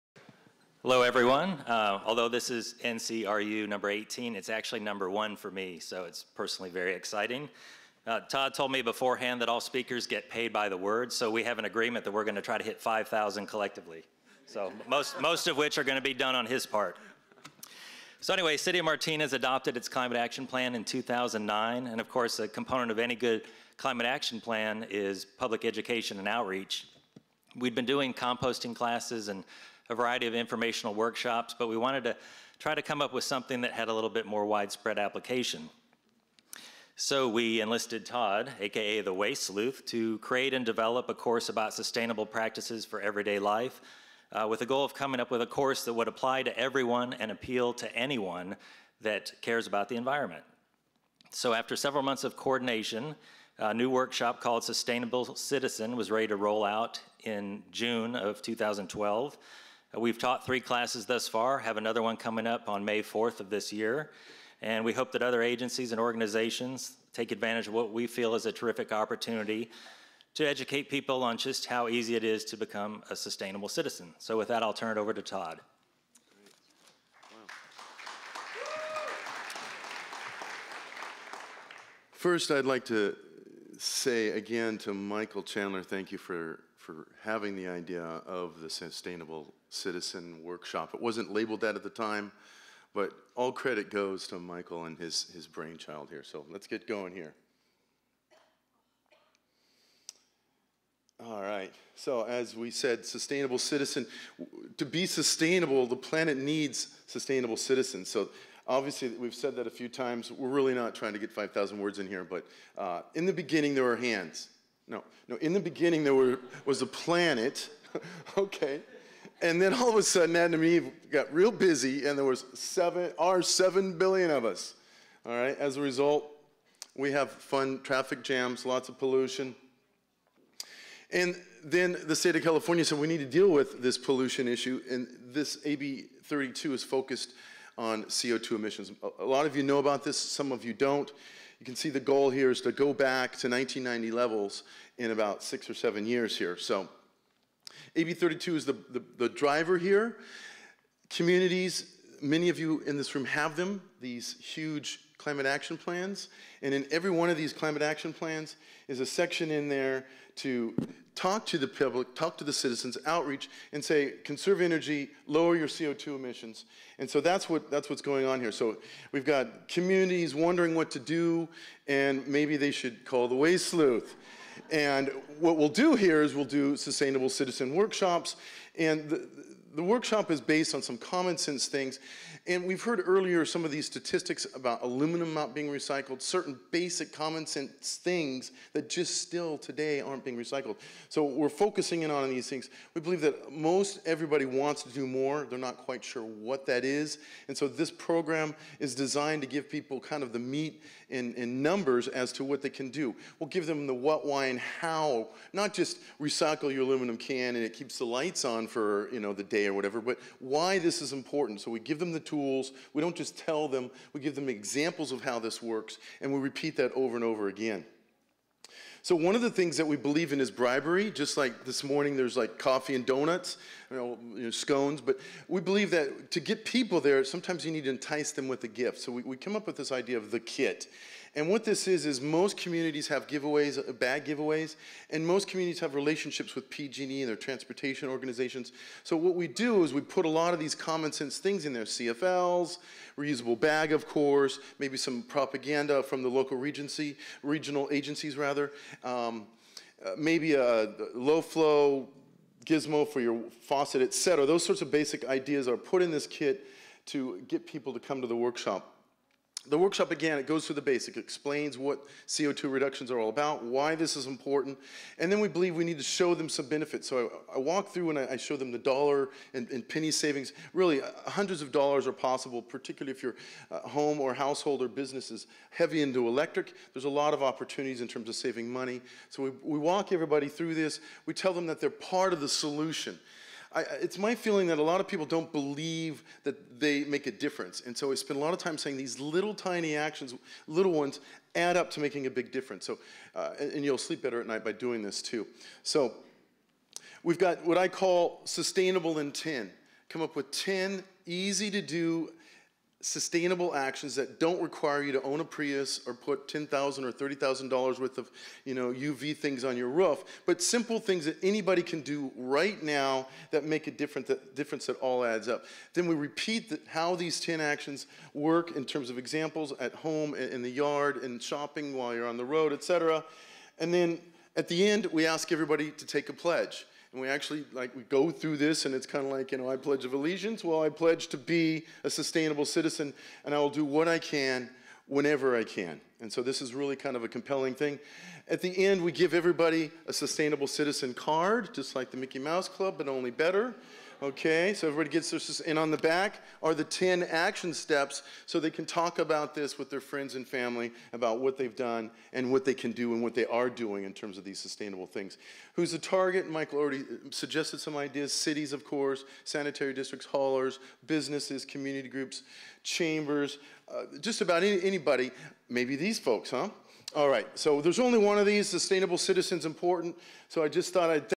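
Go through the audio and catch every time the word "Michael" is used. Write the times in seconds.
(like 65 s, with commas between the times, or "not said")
84 s, 94 s, 356 s.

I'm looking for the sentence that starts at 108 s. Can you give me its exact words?
So, obviously, we've said that a few times.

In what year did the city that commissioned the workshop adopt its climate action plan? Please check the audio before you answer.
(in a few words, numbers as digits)
2009.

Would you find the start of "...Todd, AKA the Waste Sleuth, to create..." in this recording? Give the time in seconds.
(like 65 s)
38 s.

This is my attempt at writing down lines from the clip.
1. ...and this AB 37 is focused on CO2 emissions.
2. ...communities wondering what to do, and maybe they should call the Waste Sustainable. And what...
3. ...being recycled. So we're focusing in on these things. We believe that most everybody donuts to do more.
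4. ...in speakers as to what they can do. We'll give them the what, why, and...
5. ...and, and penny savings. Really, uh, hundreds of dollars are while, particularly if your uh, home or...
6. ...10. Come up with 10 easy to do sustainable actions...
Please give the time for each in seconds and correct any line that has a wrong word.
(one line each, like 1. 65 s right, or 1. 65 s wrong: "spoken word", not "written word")
1. 134 s wrong: "32", not "37"
2. 169 s wrong: "Sleuth", not "Sustainable"
3. 190 s wrong: "wants", not "donuts"
4. 201 s wrong: "numbers", not "speakers"
5. 269 s wrong: "possible", not "while"
6. 299 s right.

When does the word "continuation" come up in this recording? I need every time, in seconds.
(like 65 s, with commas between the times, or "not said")
not said.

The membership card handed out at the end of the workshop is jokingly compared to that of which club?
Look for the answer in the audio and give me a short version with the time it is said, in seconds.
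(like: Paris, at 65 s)
Mickey Mouse Club, at 342 s.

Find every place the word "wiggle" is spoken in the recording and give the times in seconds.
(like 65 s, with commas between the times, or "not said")
not said.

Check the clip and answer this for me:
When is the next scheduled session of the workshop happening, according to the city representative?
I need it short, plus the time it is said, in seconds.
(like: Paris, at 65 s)
May 4th, at 62 s.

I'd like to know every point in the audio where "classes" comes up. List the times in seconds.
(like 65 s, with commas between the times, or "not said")
28 s, 60 s.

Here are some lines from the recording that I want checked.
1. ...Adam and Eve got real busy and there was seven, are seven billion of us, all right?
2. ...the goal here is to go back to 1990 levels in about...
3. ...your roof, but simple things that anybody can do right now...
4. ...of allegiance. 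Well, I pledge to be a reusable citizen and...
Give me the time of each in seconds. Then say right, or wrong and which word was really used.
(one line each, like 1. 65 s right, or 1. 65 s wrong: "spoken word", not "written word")
1. 120 s right
2. 141 s right
3. 309 s right
4. 330 s wrong: "sustainable", not "reusable".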